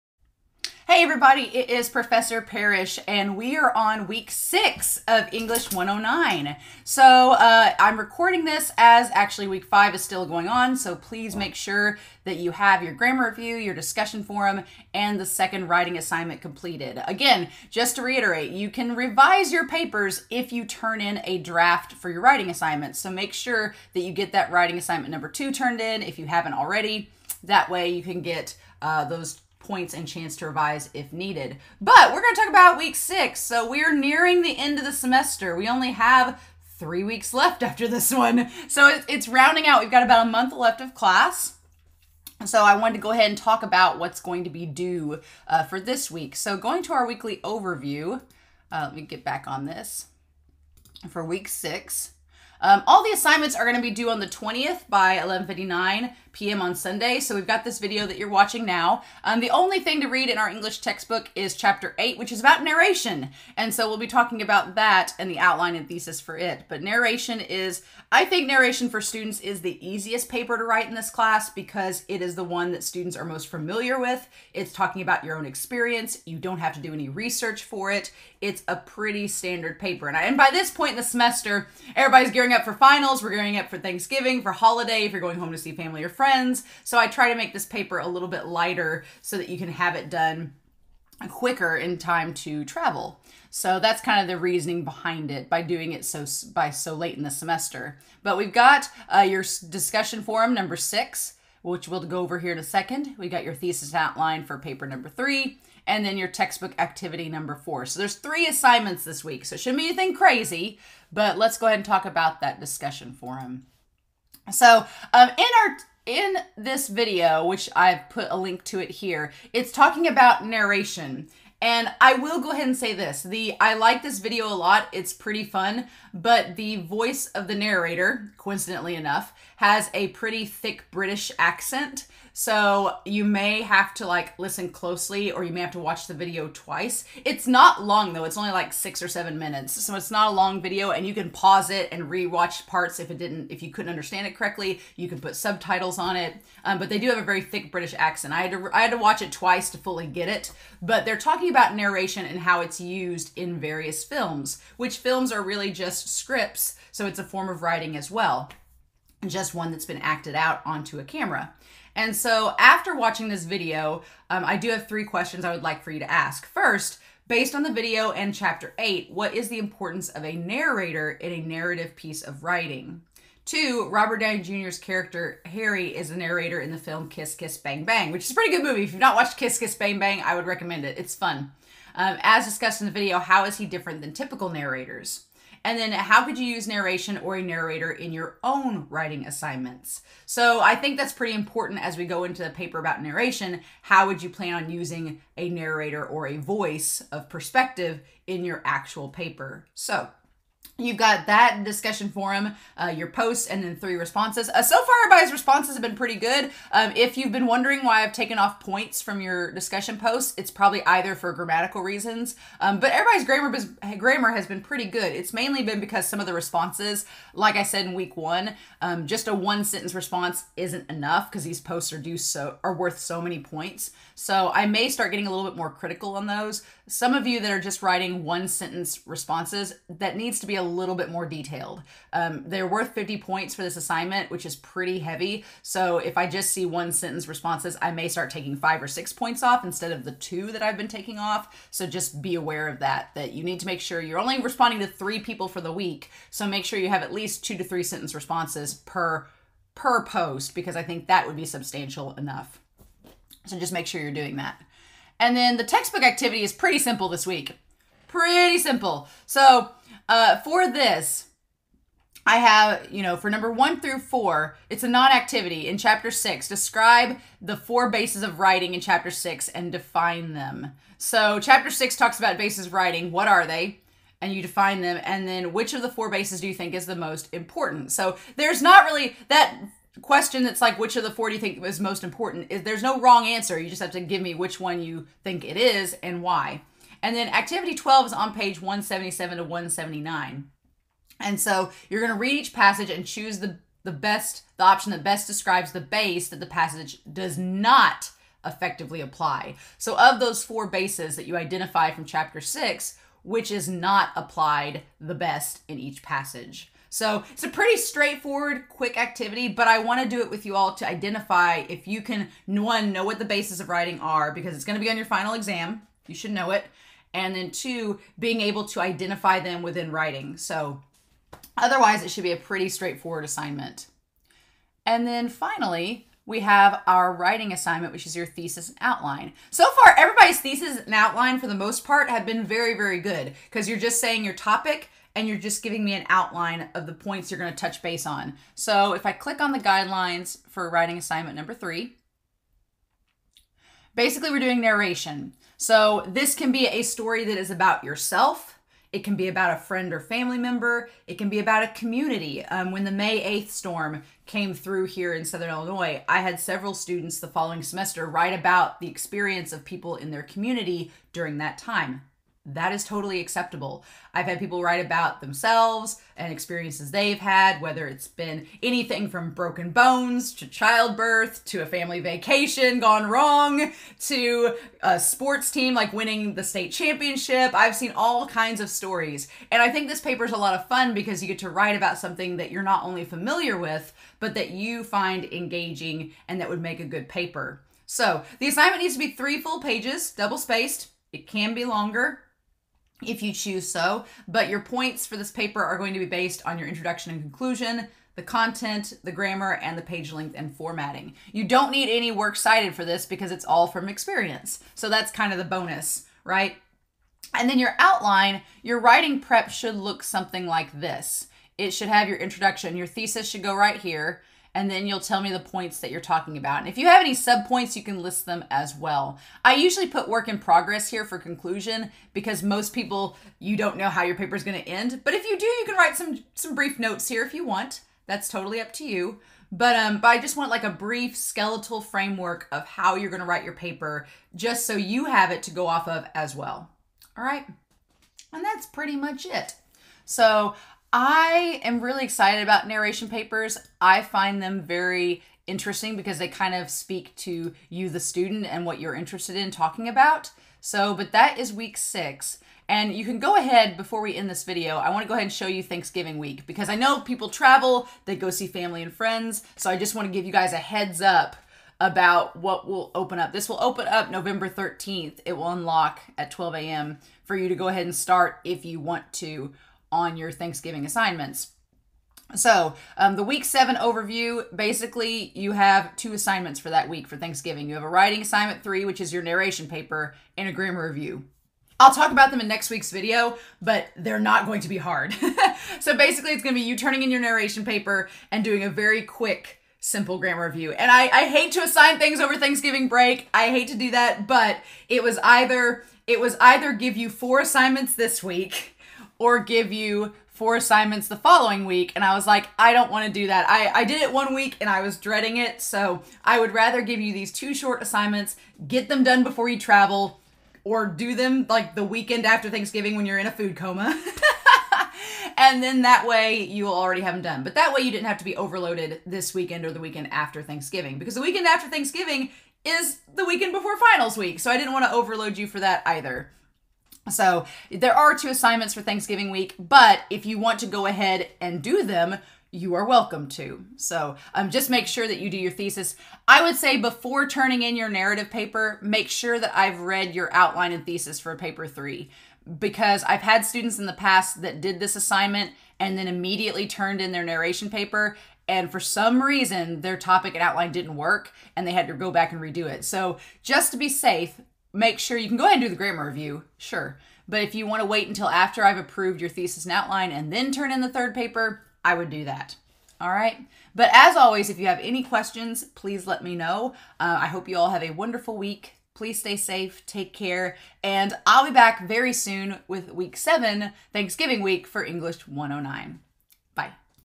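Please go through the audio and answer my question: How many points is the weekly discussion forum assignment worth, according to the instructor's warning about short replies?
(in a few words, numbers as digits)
50.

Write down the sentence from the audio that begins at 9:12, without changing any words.
So, just to be safe, make sure you can go ahead and do the grammar review, sure.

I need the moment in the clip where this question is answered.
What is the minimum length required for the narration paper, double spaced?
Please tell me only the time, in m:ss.
6:29.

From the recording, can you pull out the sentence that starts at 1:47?
So there's three assignments this week.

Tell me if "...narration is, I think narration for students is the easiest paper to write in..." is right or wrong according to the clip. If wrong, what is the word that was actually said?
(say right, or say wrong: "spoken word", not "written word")
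right.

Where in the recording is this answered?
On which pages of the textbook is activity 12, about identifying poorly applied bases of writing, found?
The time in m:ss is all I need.
4:48.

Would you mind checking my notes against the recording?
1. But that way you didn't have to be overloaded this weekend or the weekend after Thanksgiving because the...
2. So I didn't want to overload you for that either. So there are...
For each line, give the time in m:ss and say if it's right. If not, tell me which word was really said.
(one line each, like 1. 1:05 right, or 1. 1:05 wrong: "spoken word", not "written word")
1. 8:37 right
2. 8:44 right.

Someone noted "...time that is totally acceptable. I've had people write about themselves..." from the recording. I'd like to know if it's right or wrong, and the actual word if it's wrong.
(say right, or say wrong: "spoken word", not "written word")
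right.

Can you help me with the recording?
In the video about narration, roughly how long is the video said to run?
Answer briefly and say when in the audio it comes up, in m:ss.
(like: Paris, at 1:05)
6 or 7 minutes, at 2:18.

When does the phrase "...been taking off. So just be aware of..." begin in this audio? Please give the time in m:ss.
4:00.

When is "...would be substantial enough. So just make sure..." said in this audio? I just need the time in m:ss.
4:11.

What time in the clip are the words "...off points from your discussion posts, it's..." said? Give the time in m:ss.
3:28.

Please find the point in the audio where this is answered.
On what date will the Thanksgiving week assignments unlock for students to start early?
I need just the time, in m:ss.
7:44.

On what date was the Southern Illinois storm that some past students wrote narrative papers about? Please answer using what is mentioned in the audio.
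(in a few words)
May 8th.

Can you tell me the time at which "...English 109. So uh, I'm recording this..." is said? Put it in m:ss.
0:05.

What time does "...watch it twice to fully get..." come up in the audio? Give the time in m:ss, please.
2:28.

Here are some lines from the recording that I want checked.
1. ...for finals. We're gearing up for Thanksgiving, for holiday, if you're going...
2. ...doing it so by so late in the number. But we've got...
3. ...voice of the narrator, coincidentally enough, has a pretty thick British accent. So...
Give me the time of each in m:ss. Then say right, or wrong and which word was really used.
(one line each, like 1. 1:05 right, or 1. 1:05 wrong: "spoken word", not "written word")
1. 1:22 right
2. 1:35 wrong: "semester", not "number"
3. 2:06 right.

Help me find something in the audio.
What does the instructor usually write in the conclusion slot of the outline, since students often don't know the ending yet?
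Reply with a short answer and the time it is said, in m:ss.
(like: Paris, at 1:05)
Work in progress, at 7:00.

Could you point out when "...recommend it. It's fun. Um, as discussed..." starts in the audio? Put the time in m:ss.
3:00.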